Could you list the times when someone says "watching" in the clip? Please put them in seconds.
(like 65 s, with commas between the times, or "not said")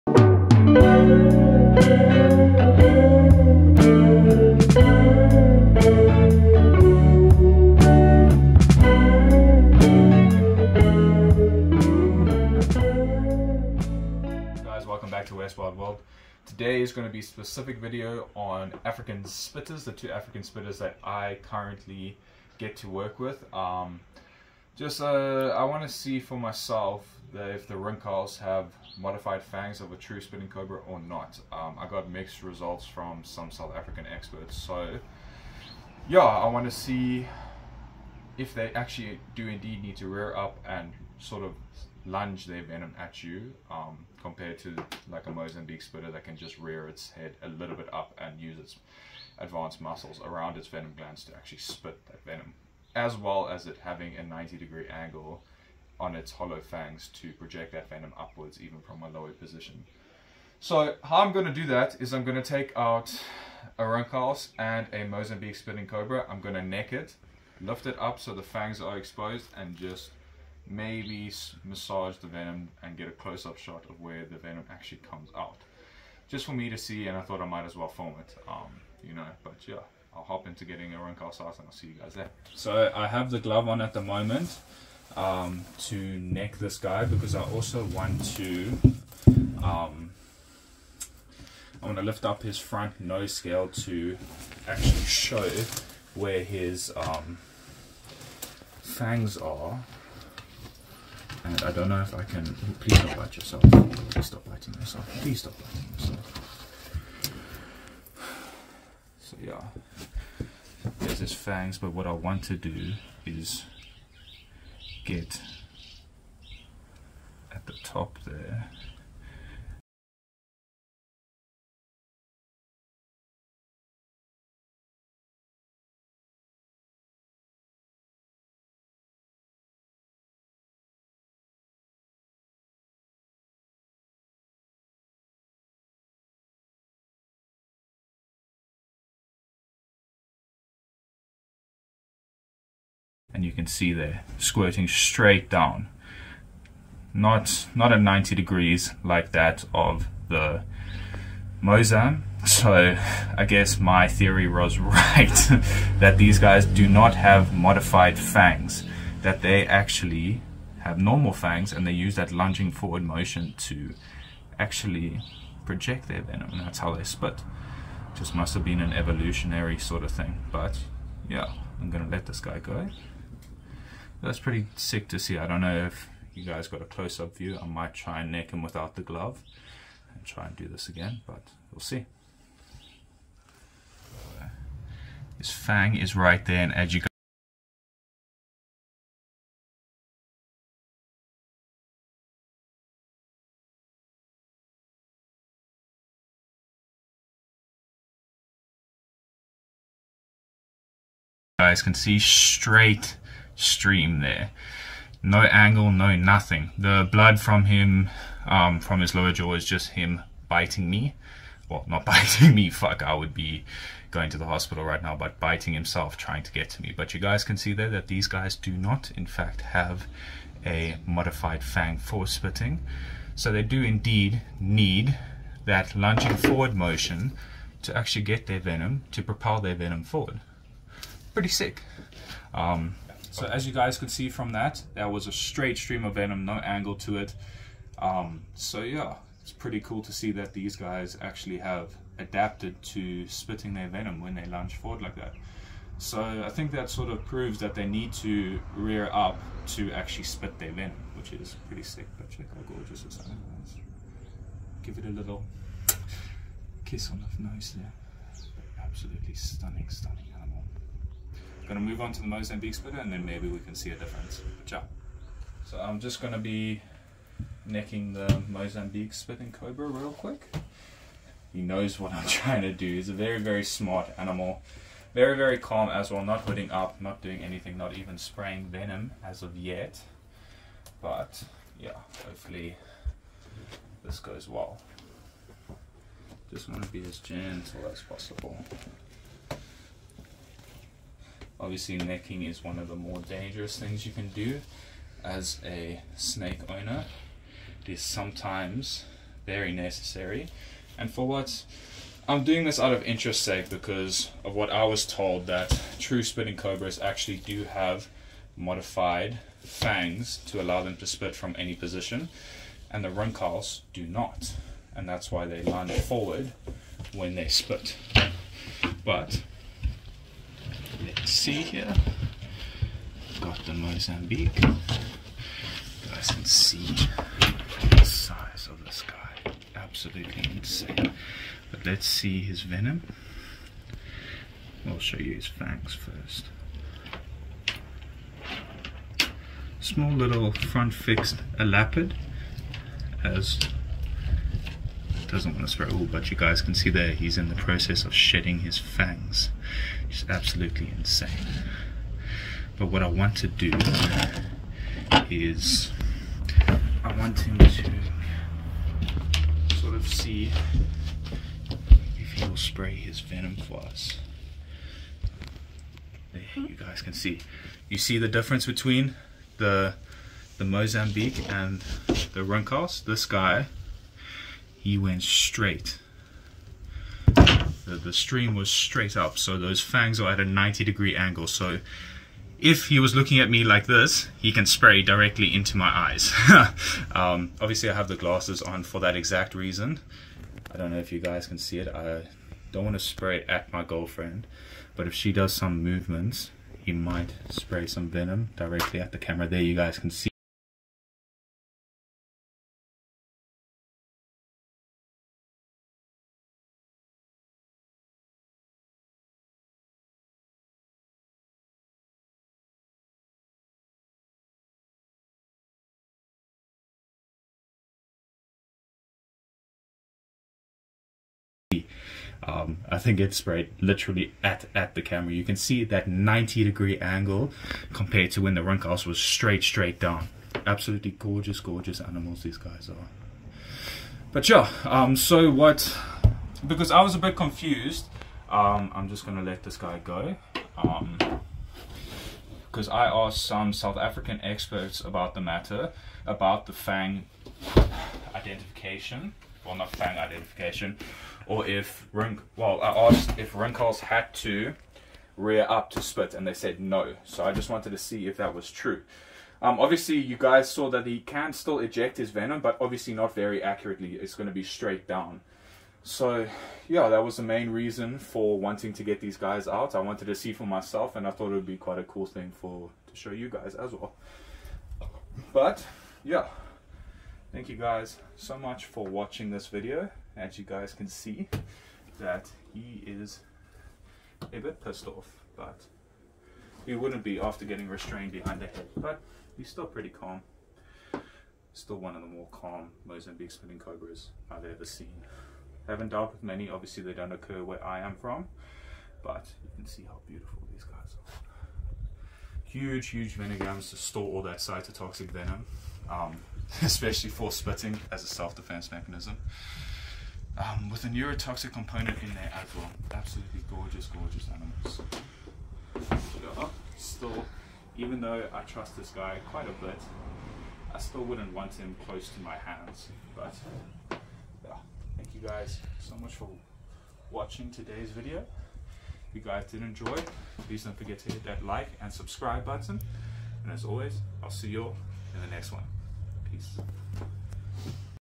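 479 s, 527 s.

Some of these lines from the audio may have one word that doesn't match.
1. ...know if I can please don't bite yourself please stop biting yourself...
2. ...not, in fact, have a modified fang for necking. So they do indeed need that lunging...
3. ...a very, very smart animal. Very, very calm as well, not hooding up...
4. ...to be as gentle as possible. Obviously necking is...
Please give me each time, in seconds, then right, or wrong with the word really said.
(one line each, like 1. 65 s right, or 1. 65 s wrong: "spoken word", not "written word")
1. 101 s right
2. 218 s wrong: "spitting", not "necking"
3. 273 s right
4. 286 s right.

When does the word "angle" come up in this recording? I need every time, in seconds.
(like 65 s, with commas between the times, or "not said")
54 s, 205 s, 236 s, 381 s, 426 s.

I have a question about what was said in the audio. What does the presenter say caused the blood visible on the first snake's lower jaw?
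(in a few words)
biting himself.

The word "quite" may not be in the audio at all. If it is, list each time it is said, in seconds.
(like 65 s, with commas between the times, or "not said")
471 s, 519 s.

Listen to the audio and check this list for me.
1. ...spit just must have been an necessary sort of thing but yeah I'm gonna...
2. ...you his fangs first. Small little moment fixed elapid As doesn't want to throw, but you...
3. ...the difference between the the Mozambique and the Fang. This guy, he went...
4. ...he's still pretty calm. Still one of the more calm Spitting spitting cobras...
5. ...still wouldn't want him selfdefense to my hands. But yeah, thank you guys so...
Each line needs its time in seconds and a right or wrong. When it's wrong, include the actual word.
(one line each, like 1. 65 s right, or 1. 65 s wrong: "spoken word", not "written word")
1. 167 s wrong: "evolutionary", not "necessary"
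2. 335 s wrong: "front", not "moment"
3. 368 s wrong: "Rinkhals", not "Fang"
4. 489 s wrong: "Mozambique", not "Spitting"
5. 520 s wrong: "close", not "selfdefense".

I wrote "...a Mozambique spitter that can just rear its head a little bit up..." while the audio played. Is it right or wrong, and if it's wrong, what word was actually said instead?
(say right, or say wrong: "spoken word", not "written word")
right.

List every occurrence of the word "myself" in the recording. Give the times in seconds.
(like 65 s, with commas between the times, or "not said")
26 s, 470 s.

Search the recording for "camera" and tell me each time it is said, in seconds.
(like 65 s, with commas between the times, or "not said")
399 s, 425 s.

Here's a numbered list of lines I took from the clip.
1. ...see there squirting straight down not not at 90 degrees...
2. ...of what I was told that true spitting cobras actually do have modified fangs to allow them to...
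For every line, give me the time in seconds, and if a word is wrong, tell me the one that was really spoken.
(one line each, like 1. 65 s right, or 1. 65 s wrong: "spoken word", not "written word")
1. 143 s right
2. 304 s right.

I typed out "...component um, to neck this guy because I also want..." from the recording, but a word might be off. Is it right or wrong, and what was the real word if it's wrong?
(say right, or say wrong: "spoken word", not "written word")
wrong: "moment", not "component".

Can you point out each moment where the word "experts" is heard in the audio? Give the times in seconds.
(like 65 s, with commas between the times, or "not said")
34 s, 444 s.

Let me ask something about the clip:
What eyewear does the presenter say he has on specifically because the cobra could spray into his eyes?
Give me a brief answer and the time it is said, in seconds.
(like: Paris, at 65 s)
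glasses, at 387 s.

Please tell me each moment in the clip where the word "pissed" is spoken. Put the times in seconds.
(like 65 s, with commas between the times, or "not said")
484 s.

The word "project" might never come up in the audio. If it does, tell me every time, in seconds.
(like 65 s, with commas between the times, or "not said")
57 s, 165 s.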